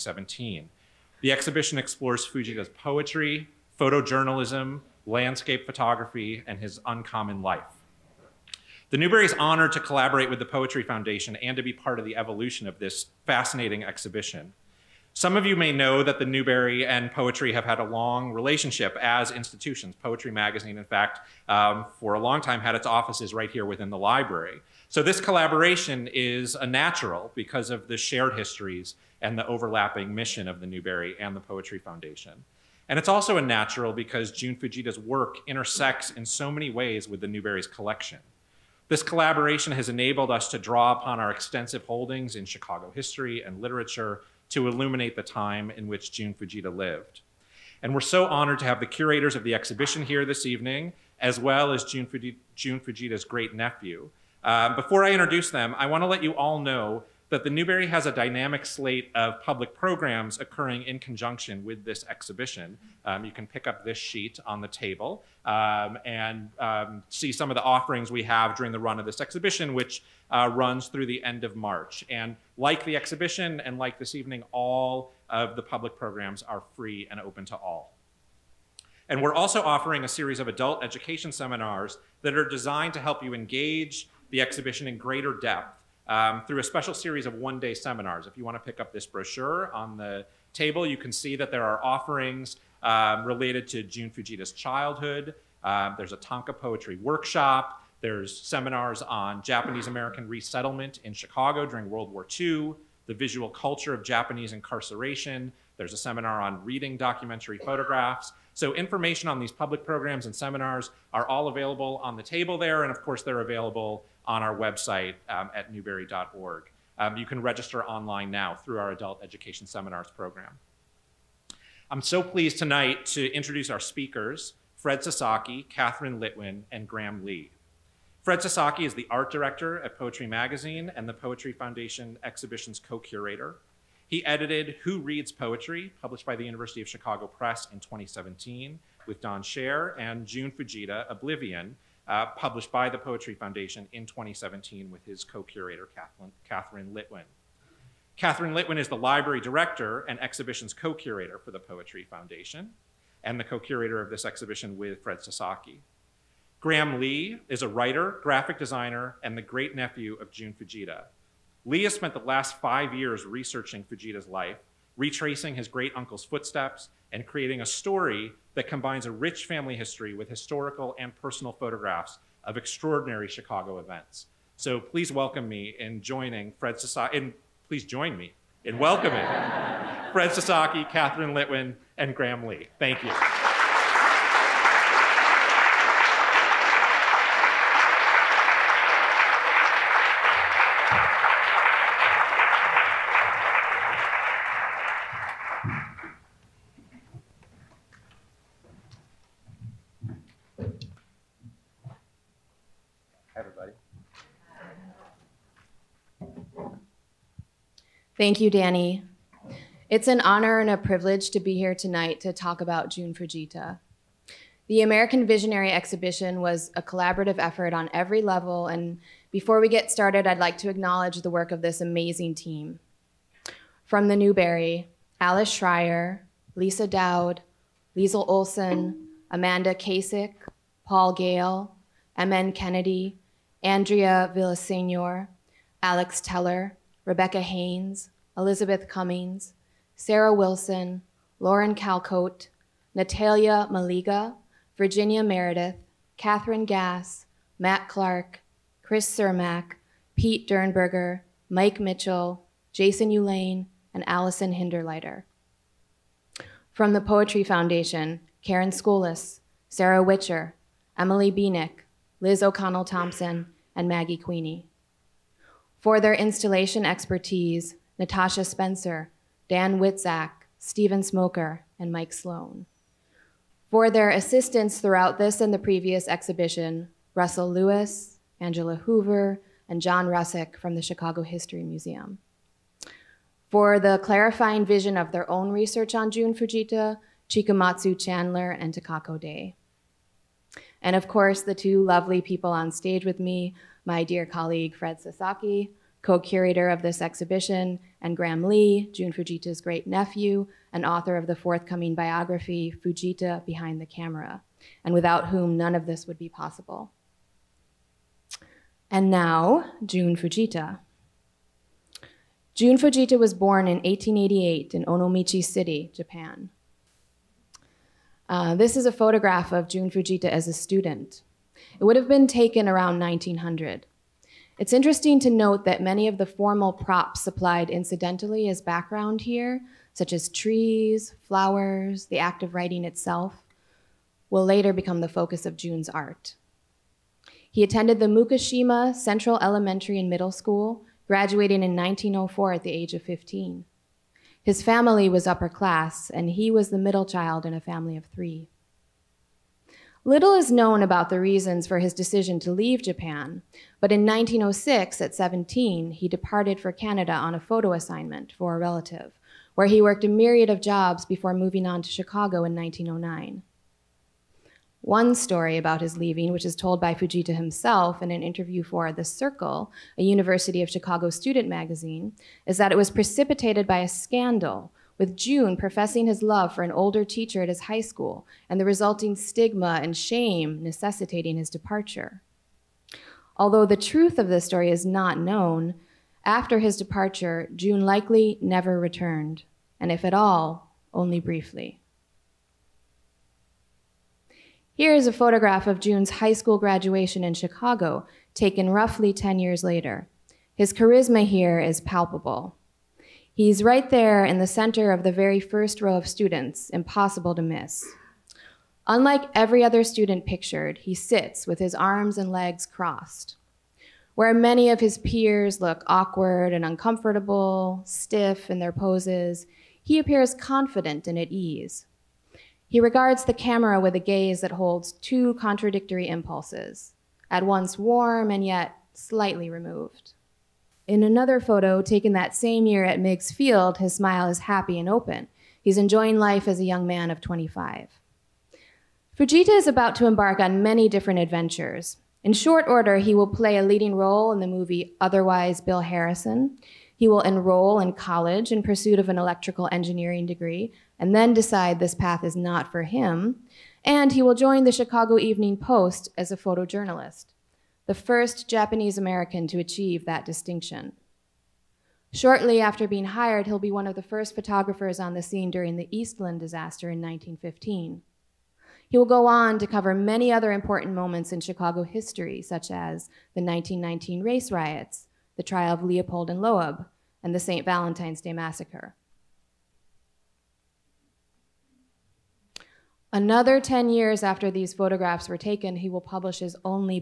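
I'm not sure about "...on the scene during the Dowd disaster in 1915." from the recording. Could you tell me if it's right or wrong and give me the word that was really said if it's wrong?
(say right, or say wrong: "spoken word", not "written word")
wrong: "Eastland", not "Dowd".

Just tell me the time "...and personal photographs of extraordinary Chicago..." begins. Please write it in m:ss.
2:50.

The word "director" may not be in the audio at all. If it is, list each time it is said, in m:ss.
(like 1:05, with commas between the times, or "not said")
2:09, 2:29.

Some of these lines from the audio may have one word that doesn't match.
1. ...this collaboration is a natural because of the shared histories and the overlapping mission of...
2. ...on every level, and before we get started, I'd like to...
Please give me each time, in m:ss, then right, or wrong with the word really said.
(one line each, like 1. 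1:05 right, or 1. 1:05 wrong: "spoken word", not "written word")
1. 0:25 right
2. 3:37 right.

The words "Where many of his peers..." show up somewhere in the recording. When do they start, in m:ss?
6:54.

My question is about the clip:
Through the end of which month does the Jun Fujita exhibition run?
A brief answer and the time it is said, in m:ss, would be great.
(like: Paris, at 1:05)
March, at 1:11.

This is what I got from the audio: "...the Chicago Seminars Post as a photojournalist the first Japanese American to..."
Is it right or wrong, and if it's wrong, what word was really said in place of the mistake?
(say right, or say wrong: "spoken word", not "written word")
wrong: "Evening", not "Seminars".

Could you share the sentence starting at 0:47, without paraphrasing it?
And we're so honored to have the curators of the exhibition here this evening, as well as Jun, Fujita's great nephew.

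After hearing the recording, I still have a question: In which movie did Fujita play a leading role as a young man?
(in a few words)
Otherwise Bill Harrison.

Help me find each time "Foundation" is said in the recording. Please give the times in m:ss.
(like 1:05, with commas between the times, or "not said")
0:10, 0:31, 2:11, 2:23, 2:32, 4:17.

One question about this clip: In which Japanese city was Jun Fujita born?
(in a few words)
Onomichi City.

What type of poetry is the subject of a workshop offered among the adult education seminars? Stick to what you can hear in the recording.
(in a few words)
Tanka.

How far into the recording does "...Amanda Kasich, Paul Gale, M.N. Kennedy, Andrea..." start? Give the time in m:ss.
3:49.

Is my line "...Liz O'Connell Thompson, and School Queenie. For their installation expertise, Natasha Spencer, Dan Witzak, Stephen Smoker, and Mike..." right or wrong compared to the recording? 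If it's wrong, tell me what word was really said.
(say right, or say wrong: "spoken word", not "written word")
wrong: "Maggie", not "School".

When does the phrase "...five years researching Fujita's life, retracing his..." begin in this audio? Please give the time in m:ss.
2:42.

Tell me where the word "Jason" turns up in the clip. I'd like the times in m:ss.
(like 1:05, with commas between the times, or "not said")
4:12.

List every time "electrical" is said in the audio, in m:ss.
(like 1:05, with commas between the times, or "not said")
7:29.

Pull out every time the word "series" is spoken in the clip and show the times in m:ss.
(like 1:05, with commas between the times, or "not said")
1:20, 1:26.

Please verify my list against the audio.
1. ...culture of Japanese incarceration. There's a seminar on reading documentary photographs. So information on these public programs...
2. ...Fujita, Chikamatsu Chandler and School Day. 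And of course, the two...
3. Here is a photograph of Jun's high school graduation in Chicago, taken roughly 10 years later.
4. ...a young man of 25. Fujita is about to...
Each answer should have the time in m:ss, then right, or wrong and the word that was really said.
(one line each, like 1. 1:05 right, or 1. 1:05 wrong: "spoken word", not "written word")
1. 1:43 right
2. 4:46 wrong: "Takako", not "School"
3. 6:34 right
4. 7:16 right.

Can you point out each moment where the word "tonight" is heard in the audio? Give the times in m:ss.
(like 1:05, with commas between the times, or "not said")
2:02, 3:31.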